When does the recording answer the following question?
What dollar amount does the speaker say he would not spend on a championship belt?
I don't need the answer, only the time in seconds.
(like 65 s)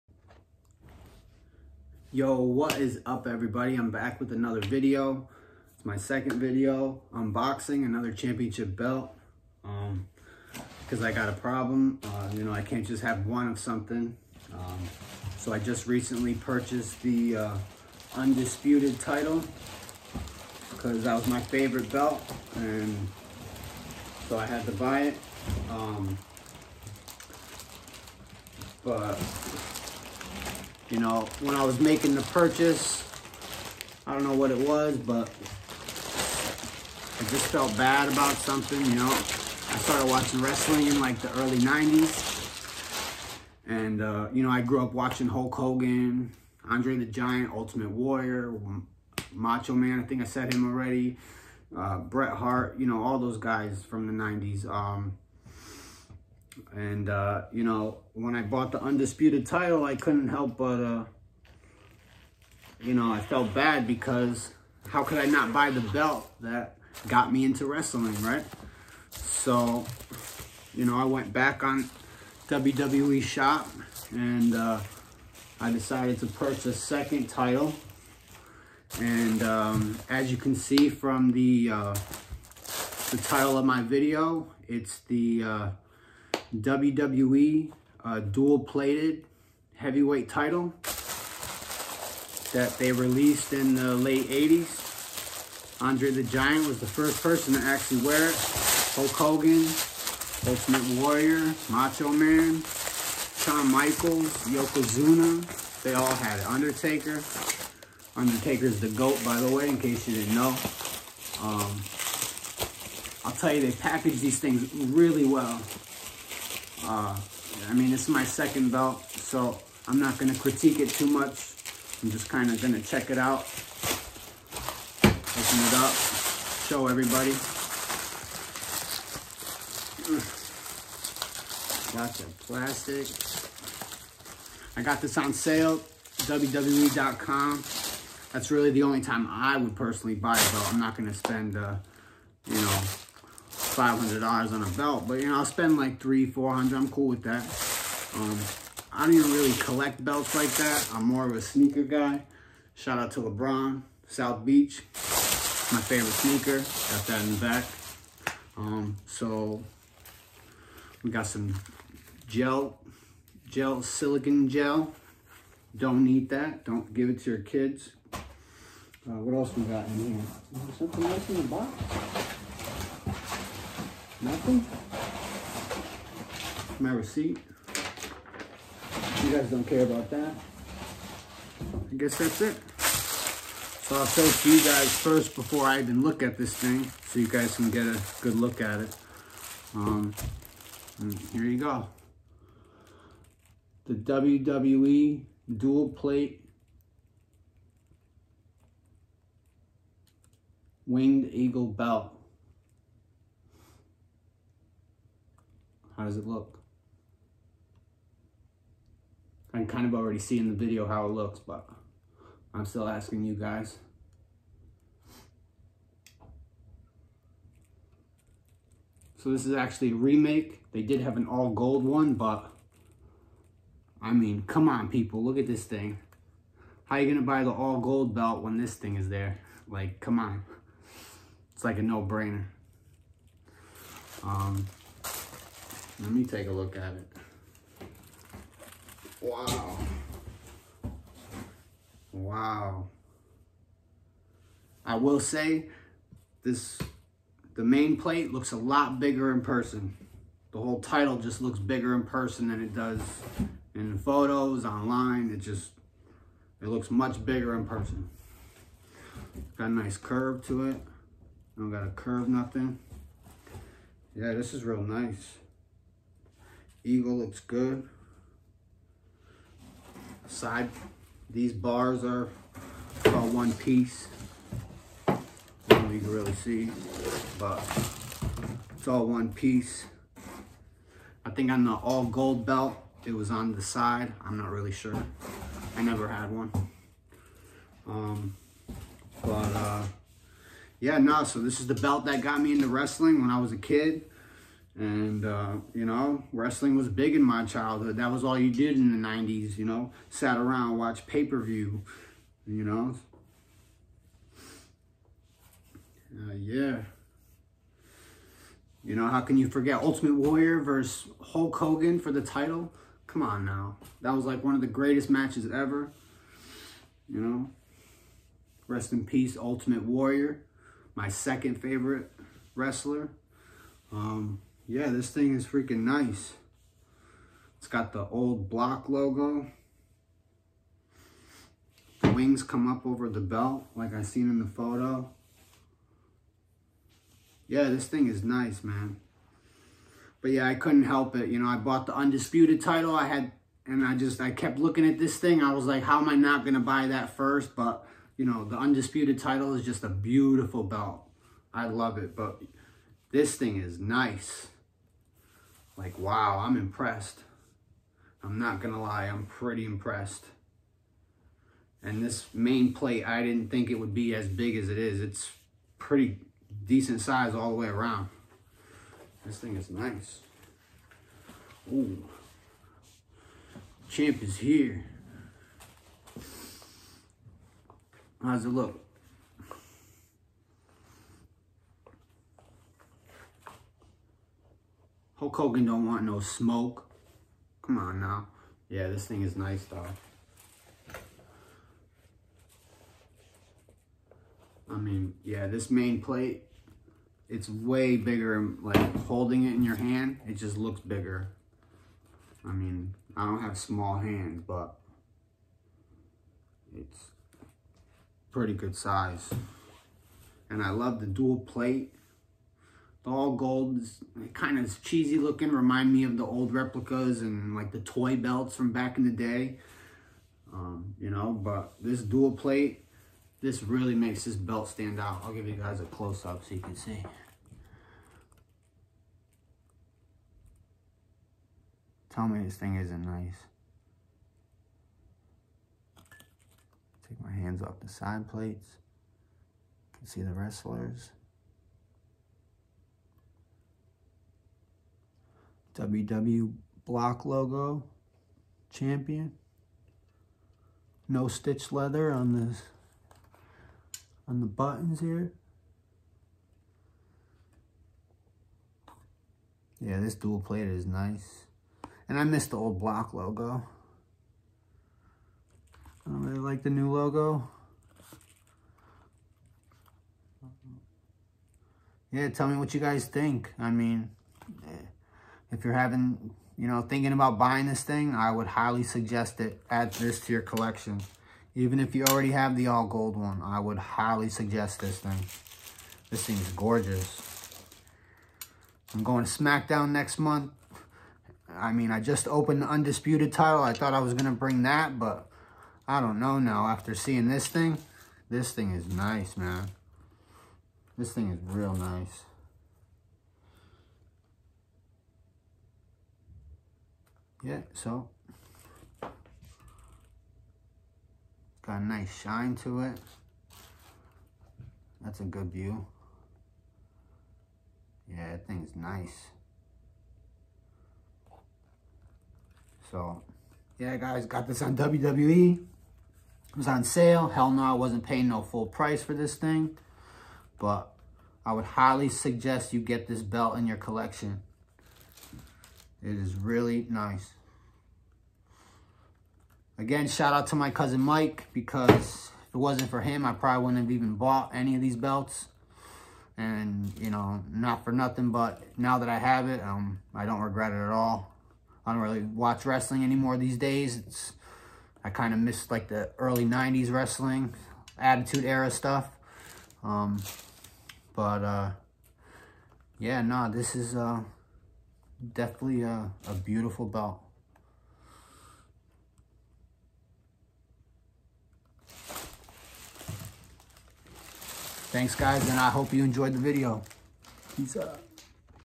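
143 s.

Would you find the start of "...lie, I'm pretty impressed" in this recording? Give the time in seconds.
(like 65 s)
358 s.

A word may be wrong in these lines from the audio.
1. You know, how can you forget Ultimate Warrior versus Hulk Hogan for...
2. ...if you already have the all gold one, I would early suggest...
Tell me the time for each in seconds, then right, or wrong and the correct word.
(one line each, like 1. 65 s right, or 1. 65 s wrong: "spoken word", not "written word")
1. 308 s right
2. 481 s wrong: "highly", not "early".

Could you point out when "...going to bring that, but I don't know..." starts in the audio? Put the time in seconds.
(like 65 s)
494 s.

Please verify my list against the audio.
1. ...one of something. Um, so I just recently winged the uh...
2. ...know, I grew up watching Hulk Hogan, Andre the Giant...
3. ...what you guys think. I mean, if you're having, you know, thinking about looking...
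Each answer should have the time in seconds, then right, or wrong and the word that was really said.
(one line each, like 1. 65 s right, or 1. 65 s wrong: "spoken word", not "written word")
1. 13 s wrong: "purchased", not "winged"
2. 44 s right
3. 472 s wrong: "buying", not "looking".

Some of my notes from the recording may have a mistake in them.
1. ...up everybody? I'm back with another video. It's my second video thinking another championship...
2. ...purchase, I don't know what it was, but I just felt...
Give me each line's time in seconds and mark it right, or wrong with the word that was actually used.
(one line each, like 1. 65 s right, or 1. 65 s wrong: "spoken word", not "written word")
1. 3 s wrong: "unboxing", not "thinking"
2. 32 s right.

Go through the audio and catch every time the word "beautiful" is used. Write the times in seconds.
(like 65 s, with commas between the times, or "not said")
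349 s, 566 s.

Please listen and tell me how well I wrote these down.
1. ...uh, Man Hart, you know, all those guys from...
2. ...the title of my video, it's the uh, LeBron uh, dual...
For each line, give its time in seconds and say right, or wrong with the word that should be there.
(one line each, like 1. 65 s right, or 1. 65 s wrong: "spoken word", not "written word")
1. 51 s wrong: "Bret", not "Man"
2. 83 s wrong: "WWE", not "LeBron".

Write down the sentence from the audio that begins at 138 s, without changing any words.
That's really the only time I would personally buy it, though.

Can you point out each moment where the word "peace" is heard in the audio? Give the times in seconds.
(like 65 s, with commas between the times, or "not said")
319 s, 577 s.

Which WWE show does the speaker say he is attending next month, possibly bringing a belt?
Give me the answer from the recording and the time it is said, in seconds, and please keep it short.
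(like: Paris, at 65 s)
SmackDown, at 489 s.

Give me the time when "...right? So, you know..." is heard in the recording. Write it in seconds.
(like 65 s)
68 s.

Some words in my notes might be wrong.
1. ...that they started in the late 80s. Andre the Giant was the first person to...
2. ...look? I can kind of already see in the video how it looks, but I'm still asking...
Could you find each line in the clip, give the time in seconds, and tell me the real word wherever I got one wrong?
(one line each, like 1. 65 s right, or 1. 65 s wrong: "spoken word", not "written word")
1. 92 s wrong: "released", not "started"
2. 206 s right.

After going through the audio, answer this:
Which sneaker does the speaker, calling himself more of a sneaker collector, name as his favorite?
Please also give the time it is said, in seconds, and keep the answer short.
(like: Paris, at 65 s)
LeBron South Beach, at 153 s.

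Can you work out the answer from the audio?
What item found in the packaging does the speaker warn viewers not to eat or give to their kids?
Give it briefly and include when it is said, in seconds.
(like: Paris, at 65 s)
Silicon gel, at 163 s.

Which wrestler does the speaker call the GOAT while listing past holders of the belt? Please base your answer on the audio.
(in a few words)
Undertaker.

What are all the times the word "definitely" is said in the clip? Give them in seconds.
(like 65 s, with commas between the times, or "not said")
565 s.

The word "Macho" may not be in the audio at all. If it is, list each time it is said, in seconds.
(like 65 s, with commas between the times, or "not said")
49 s, 101 s.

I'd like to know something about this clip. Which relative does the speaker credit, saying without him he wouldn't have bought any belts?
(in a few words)
Cousin Mike.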